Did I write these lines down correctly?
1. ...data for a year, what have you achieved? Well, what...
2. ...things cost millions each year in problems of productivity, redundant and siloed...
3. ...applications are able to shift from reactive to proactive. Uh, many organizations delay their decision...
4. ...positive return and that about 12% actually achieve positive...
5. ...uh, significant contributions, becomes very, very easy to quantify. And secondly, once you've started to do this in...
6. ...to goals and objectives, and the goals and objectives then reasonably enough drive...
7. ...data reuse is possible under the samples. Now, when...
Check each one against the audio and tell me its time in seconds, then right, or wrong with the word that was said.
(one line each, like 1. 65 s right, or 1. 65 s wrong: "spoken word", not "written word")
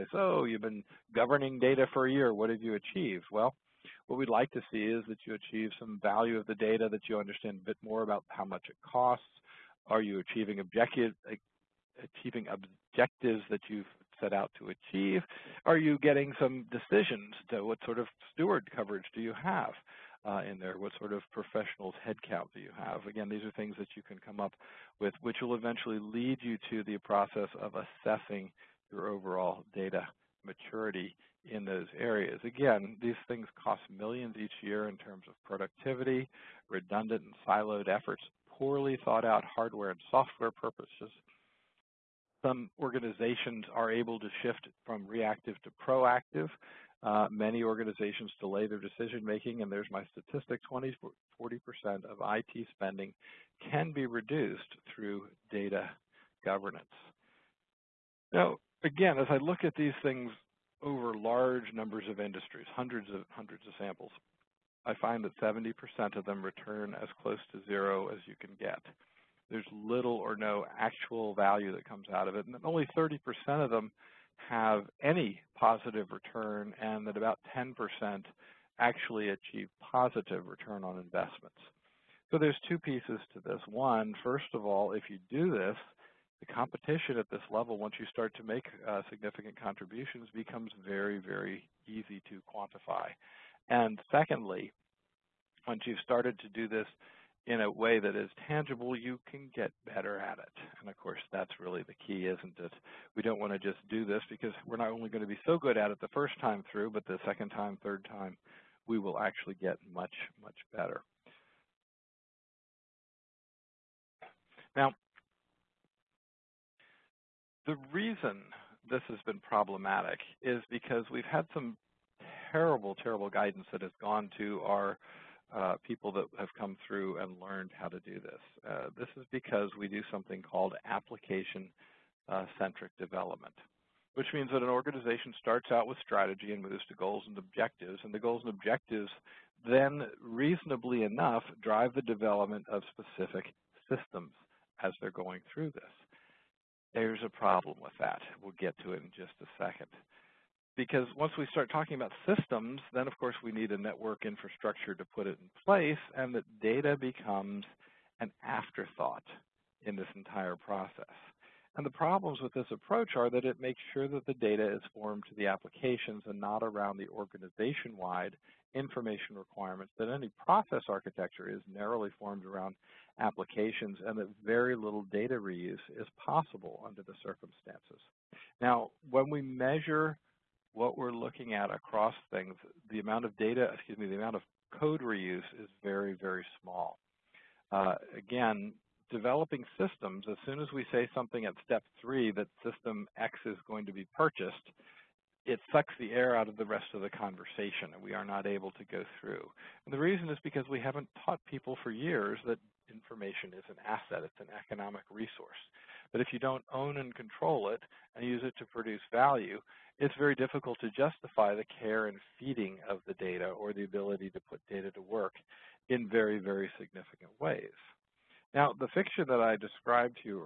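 1. 1 s right
2. 33 s wrong: "terms", not "problems"
3. 42 s wrong: "organizations", not "applications"
4. 75 s wrong: "10", not "12"
5. 88 s right
6. 136 s right
7. 175 s wrong: "circumstances", not "samples".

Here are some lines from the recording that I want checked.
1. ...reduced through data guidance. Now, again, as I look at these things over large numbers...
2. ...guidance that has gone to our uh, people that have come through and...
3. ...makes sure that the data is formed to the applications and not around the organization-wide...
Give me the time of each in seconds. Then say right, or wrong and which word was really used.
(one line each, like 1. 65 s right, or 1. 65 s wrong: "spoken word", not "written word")
1. 54 s wrong: "governance", not "guidance"
2. 123 s right
3. 163 s right.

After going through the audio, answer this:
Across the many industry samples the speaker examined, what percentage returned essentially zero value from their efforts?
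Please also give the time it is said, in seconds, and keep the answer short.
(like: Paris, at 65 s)
70%, at 65 s.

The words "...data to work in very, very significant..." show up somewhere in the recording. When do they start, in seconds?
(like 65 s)
214 s.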